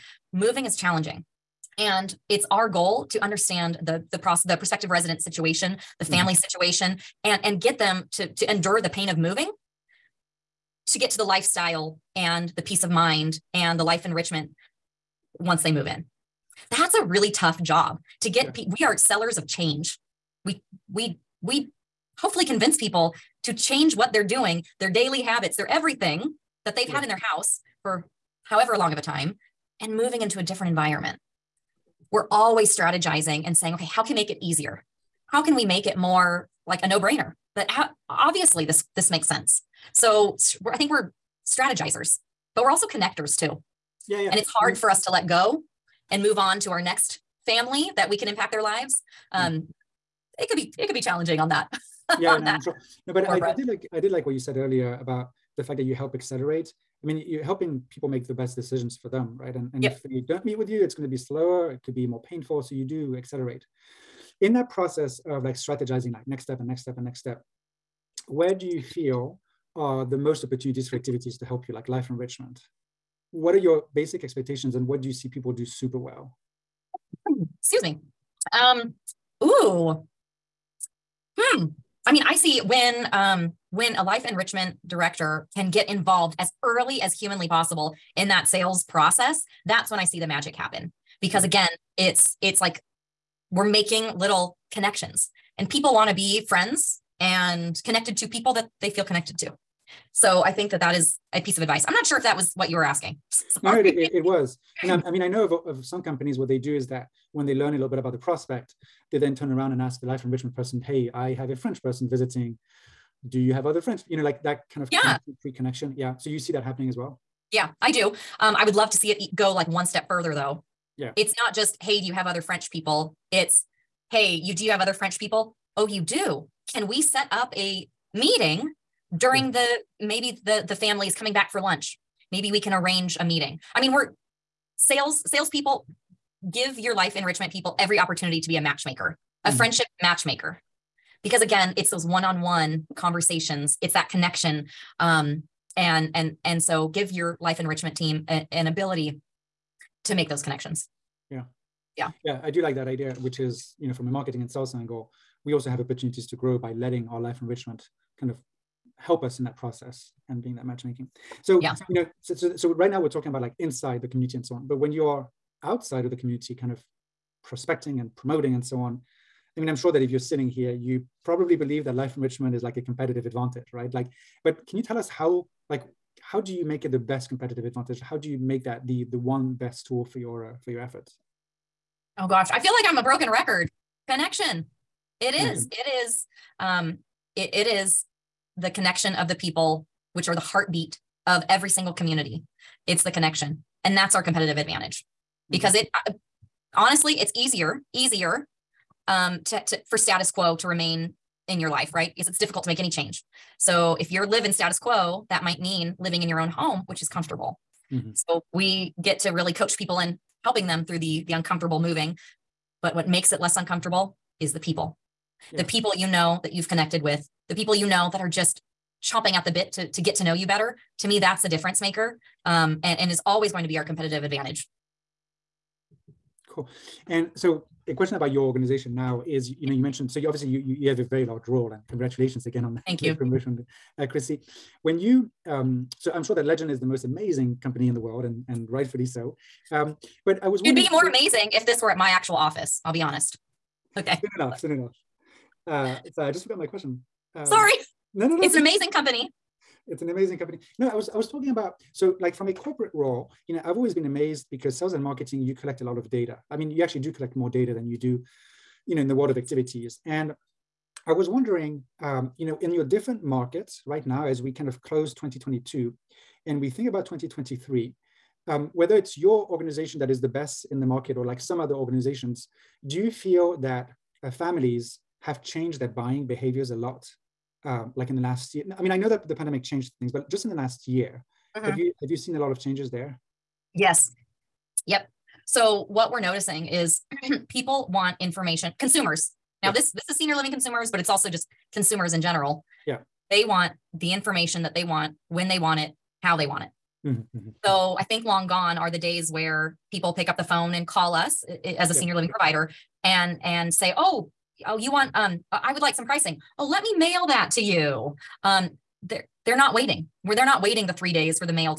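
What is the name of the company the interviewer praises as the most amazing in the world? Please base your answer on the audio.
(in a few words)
Legend.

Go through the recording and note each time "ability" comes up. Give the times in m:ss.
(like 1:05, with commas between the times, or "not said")
2:28.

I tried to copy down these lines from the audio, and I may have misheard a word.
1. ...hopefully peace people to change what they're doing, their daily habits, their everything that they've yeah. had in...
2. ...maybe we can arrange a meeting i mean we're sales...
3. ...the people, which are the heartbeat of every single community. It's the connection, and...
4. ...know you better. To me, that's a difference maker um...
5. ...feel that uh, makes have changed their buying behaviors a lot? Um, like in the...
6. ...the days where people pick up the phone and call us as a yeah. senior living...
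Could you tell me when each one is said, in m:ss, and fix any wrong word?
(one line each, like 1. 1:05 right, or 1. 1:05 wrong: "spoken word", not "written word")
1. 0:22 wrong: "convince", not "peace"
2. 2:12 right
3. 3:09 right
4. 3:40 right
5. 4:33 wrong: "families", not "makes"
6. 4:58 right.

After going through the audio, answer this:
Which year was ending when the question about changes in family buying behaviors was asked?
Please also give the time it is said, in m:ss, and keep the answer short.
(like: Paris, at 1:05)
2022, at 4:25.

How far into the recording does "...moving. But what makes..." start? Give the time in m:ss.
3:31.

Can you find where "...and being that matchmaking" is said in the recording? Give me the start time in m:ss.
2:40.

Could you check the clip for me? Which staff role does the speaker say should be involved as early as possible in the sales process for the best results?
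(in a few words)
Life enrichment director.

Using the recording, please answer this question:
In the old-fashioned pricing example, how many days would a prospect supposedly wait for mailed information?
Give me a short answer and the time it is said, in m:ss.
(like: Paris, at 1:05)
3, at 5:10.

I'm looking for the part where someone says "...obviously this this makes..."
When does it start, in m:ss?
0:38.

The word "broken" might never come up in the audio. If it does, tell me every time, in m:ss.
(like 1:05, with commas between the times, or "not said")
3:03.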